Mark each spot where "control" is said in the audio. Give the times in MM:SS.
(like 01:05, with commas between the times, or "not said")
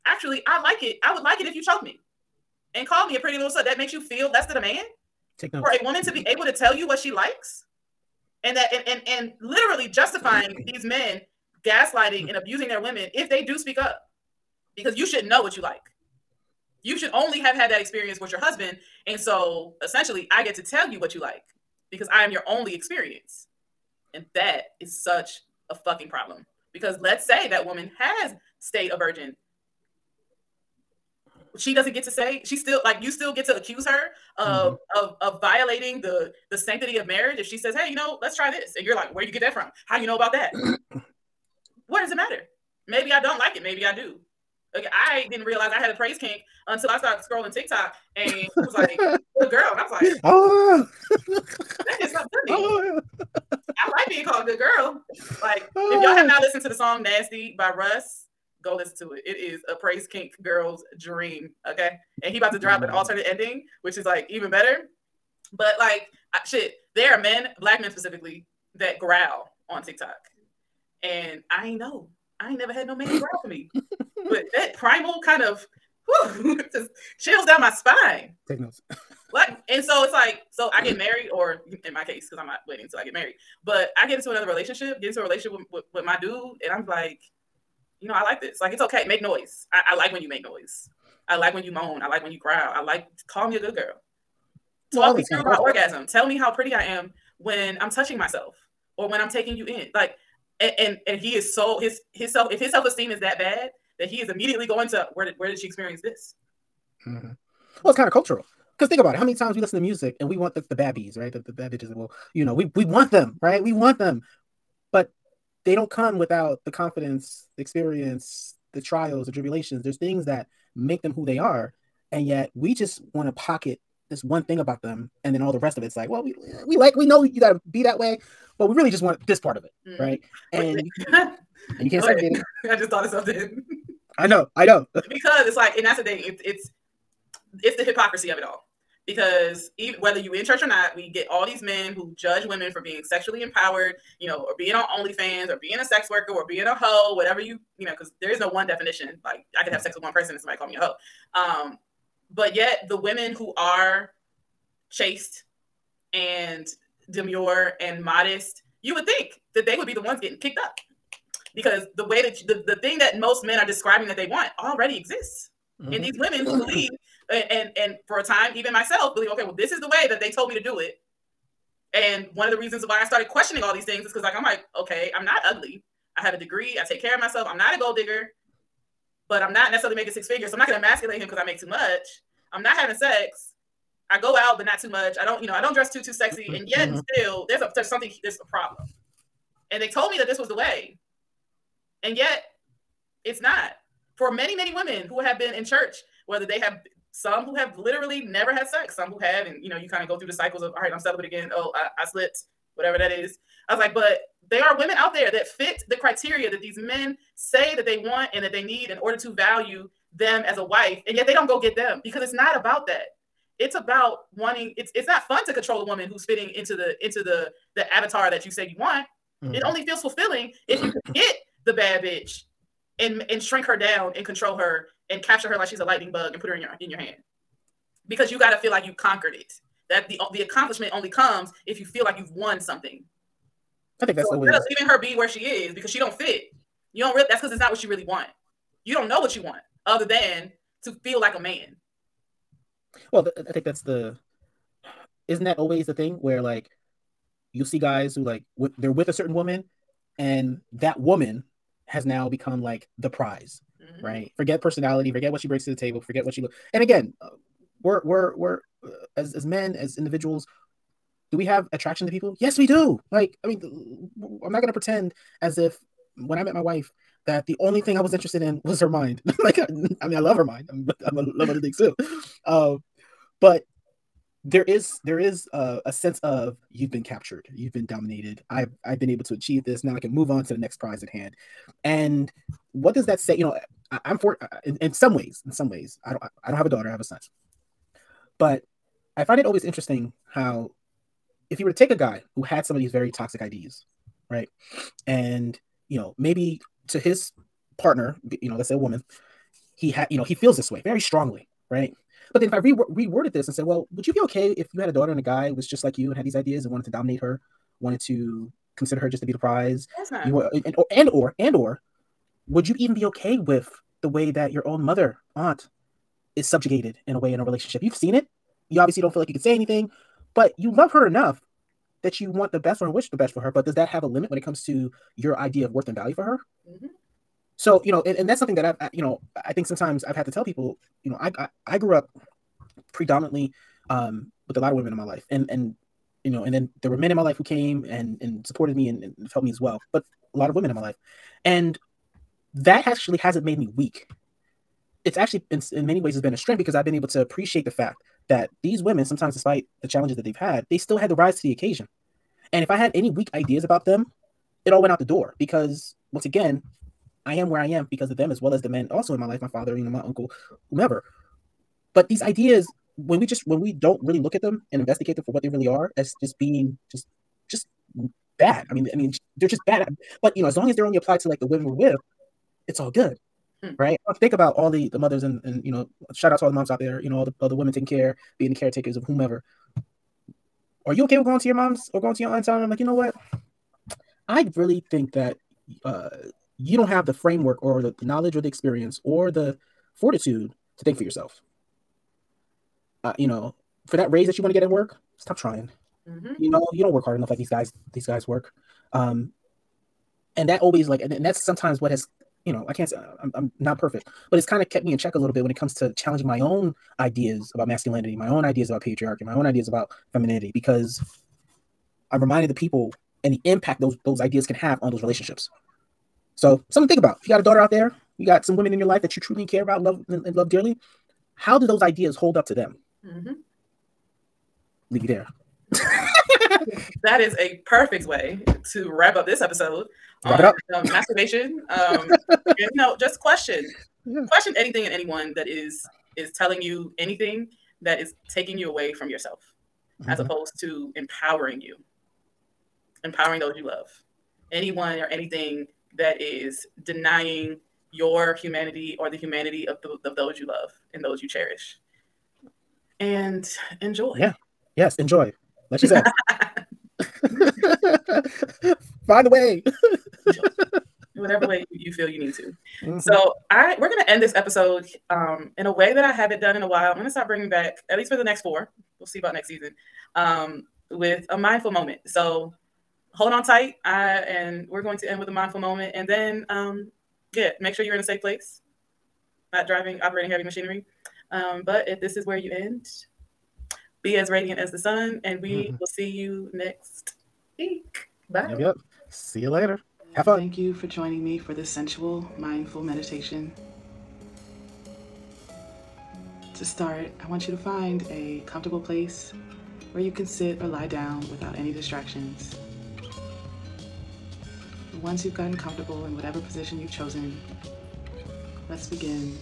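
03:35, 03:44.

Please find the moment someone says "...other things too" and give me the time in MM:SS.
04:31.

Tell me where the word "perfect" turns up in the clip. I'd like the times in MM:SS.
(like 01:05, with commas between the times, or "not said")
06:43, 07:07.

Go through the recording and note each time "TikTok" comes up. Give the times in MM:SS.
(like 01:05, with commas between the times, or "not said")
00:47, 01:09.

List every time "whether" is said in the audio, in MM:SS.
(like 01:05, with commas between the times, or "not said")
02:20, 03:16.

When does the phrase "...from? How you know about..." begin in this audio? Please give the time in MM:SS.
00:39.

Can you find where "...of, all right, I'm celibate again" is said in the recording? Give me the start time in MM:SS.
03:20.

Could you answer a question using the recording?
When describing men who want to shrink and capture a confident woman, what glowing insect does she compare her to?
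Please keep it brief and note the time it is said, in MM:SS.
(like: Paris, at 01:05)
Lightning bug, at 03:45.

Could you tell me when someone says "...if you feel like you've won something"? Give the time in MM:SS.
03:51.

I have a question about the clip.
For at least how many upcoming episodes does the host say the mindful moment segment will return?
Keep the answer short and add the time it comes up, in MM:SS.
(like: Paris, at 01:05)
4, at 07:48.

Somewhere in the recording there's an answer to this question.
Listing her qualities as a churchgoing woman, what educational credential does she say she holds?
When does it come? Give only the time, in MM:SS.
02:56.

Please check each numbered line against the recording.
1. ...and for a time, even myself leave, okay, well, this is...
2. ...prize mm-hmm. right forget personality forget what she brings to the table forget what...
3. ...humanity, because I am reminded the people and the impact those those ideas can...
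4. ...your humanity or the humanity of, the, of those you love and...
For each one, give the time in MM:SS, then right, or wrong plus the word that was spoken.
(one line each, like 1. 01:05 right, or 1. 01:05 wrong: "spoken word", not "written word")
1. 02:47 wrong: "believe", not "leave"
2. 04:13 right
3. 06:50 wrong: "femininity", not "humanity"
4. 07:27 right.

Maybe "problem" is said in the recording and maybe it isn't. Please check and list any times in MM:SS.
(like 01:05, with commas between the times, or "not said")
00:26, 03:08.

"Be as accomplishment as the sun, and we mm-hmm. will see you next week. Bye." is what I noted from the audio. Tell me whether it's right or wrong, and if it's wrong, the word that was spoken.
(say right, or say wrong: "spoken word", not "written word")
wrong: "radiant", not "accomplishment".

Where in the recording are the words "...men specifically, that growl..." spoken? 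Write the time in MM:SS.
01:07.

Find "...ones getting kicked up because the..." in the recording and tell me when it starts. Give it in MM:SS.
02:40.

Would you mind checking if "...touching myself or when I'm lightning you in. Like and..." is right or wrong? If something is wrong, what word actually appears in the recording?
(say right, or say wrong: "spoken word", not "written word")
wrong: "taking", not "lightning".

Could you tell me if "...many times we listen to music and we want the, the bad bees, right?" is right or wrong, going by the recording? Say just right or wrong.
right.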